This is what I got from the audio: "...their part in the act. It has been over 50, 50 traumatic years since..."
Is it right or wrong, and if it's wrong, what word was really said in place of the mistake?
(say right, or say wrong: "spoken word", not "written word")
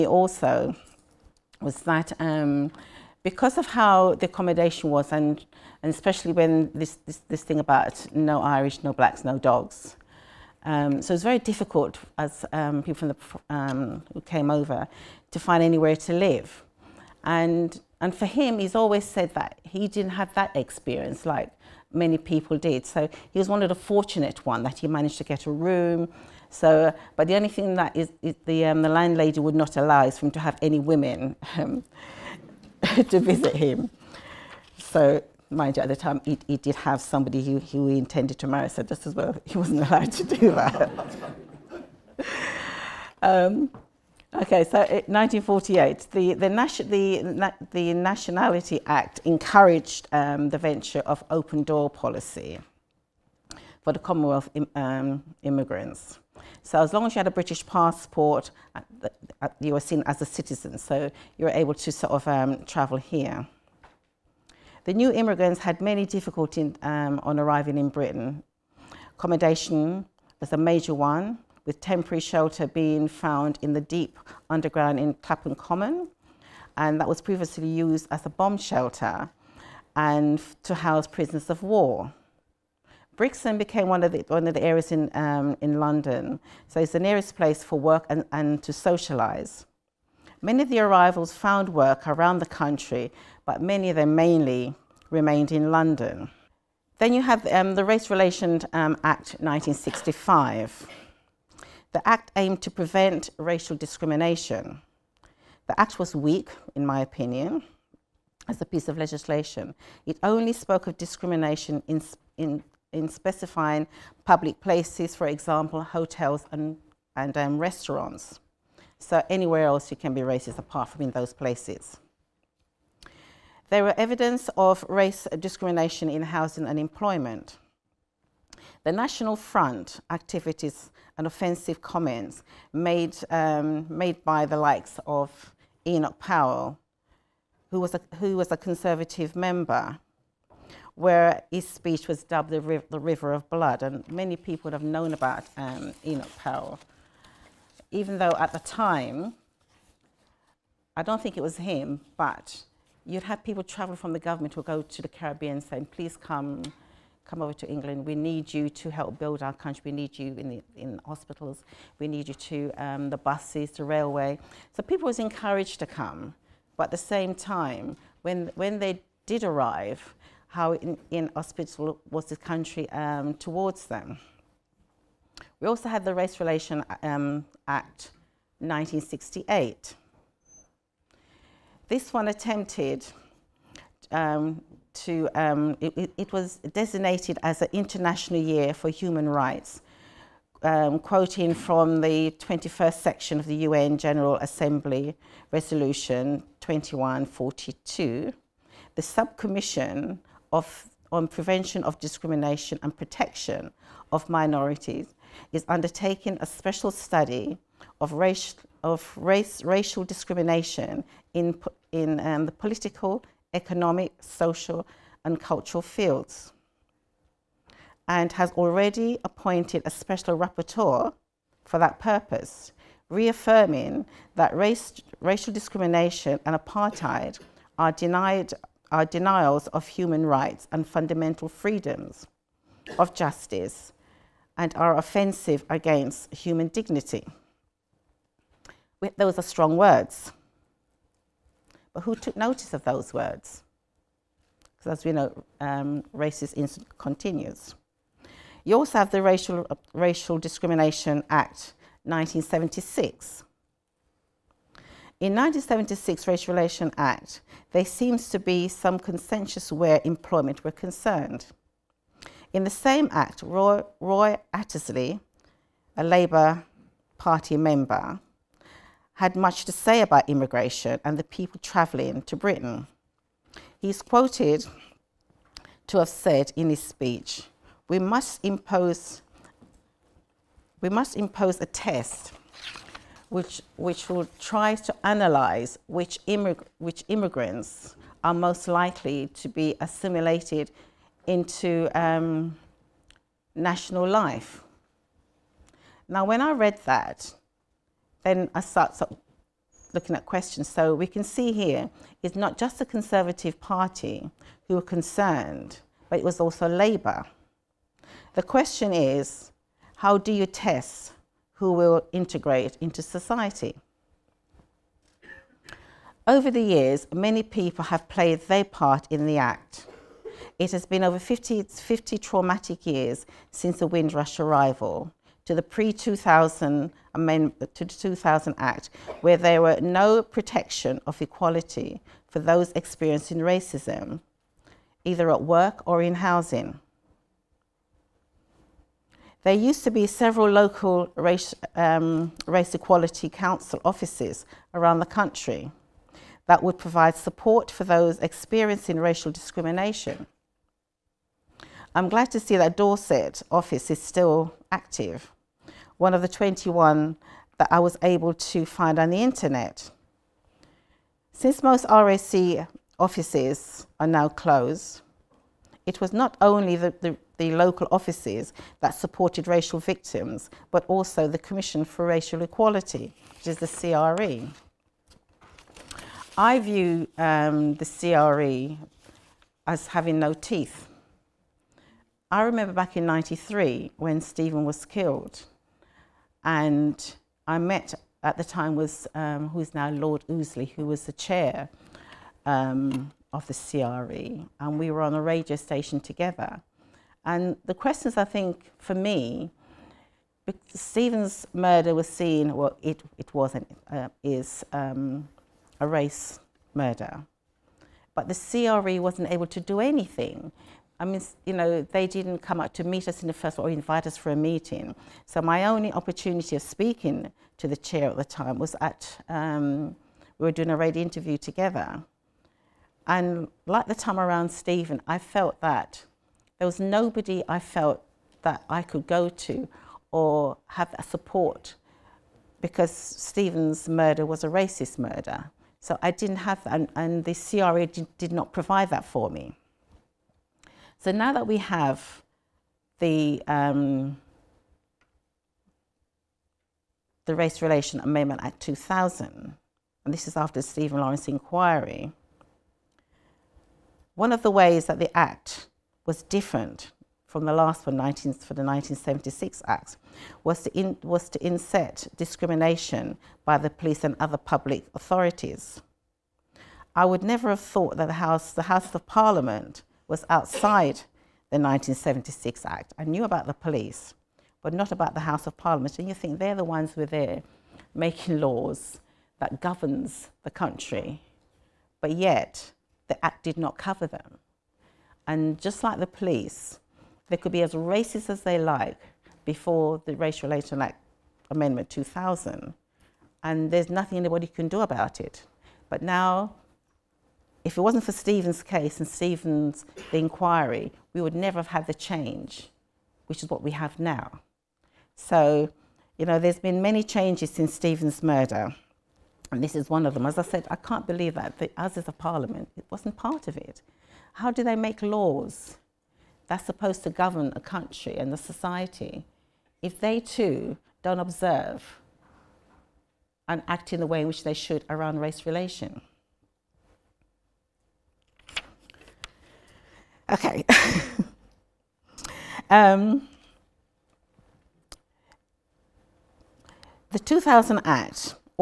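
right.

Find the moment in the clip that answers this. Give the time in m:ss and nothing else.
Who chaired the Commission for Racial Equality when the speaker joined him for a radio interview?
6:29.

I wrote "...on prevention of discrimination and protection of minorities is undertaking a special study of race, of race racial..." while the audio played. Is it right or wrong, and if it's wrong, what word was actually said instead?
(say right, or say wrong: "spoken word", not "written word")
right.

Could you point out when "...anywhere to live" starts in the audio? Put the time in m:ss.
0:15.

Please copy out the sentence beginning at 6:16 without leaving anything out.
I view um, the CRE as having no teeth.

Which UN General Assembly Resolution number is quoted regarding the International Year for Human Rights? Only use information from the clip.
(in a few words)
2142.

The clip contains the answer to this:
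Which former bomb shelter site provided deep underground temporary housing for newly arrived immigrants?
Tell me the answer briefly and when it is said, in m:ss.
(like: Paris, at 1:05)
Clapham Common, at 1:15.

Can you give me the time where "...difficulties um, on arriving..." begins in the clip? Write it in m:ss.
1:06.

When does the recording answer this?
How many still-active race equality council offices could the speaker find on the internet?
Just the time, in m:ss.
5:56.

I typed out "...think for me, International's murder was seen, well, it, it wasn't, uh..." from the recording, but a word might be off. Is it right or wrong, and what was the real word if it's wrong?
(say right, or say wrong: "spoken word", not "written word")
wrong: "Stephen", not "International".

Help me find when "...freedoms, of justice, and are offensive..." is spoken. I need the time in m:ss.
3:51.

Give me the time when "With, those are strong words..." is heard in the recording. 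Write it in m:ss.
3:59.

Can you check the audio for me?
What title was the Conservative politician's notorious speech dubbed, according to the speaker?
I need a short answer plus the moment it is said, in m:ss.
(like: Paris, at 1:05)
River of Blood, at 2:22.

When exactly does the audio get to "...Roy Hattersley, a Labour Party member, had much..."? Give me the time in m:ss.
4:23.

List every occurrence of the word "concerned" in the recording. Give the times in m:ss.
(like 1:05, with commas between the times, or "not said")
4:20, 5:04.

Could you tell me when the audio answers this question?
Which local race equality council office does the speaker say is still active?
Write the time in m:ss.
5:52.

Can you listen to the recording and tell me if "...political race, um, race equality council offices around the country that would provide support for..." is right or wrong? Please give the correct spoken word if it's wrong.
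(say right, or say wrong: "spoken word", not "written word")
wrong: "local", not "political".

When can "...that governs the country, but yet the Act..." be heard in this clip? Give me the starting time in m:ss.
7:59.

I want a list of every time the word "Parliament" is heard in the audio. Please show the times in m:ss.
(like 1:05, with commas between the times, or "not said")
7:49, 7:55, 8:32.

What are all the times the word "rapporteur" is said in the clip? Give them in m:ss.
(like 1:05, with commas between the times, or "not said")
3:40.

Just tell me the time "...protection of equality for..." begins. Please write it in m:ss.
5:30.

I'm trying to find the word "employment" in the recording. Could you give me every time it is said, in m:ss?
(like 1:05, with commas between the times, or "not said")
2:06, 4:20.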